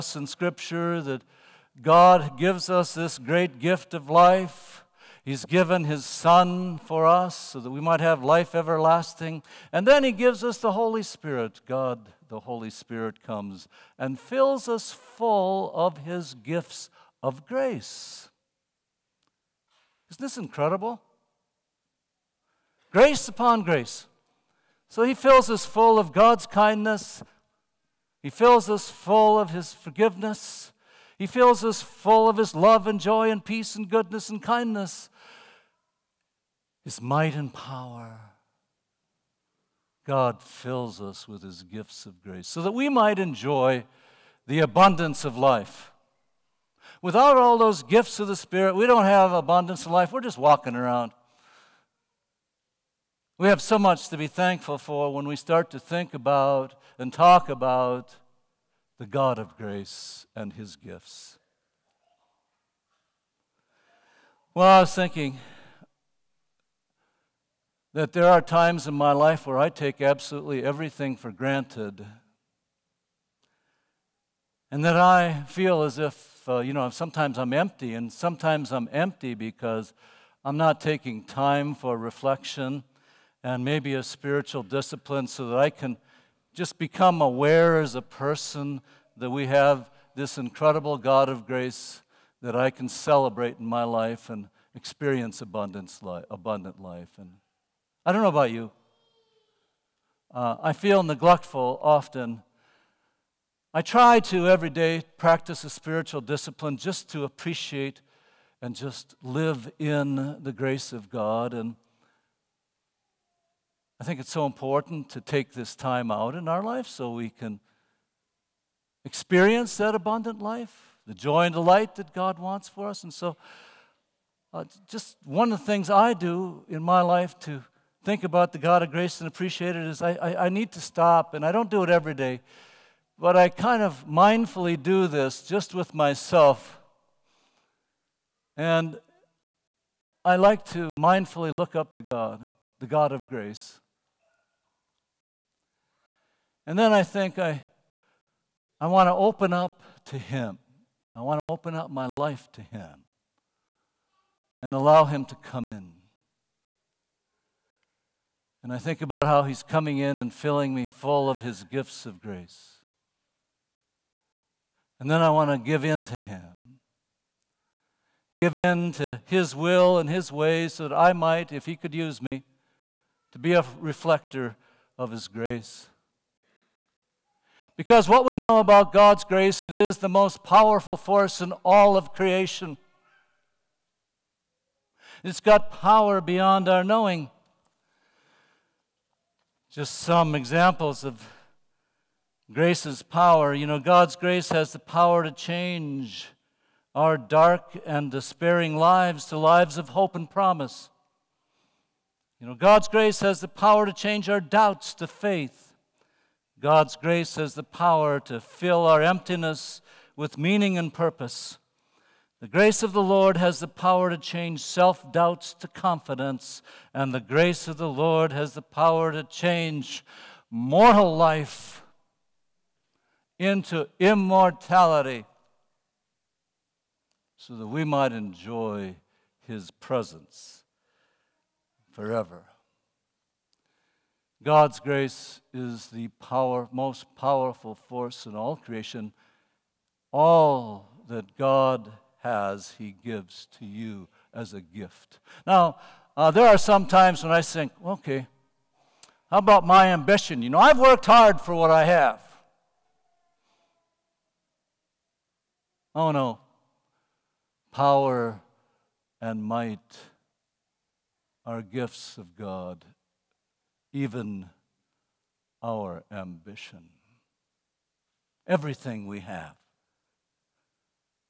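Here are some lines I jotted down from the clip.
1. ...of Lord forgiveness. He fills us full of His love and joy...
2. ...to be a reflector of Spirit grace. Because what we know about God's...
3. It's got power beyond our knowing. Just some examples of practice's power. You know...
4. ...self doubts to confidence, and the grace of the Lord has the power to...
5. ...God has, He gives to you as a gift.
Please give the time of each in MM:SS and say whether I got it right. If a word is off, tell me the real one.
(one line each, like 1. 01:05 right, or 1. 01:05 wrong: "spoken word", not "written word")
1. 00:29 wrong: "His", not "Lord"
2. 02:53 wrong: "His", not "Spirit"
3. 03:05 wrong: "grace", not "practice"
4. 03:34 right
5. 04:01 right.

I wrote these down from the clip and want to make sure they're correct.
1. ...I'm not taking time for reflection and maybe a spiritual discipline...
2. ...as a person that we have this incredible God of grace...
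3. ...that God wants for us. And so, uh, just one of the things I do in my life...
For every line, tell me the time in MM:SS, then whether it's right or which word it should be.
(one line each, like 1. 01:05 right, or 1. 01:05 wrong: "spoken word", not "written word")
1. 01:20 right
2. 01:27 right
3. 02:01 right.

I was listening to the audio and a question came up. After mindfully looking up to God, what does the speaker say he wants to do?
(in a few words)
open up to Him.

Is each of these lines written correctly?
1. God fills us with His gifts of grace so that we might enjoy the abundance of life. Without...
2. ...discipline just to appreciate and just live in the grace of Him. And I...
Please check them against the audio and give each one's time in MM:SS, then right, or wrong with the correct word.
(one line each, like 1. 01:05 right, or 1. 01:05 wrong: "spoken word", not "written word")
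1. 00:40 right
2. 01:46 wrong: "God", not "Him".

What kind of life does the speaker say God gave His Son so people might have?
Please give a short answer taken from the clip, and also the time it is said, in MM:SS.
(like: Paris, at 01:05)
life everlasting, at 00:08.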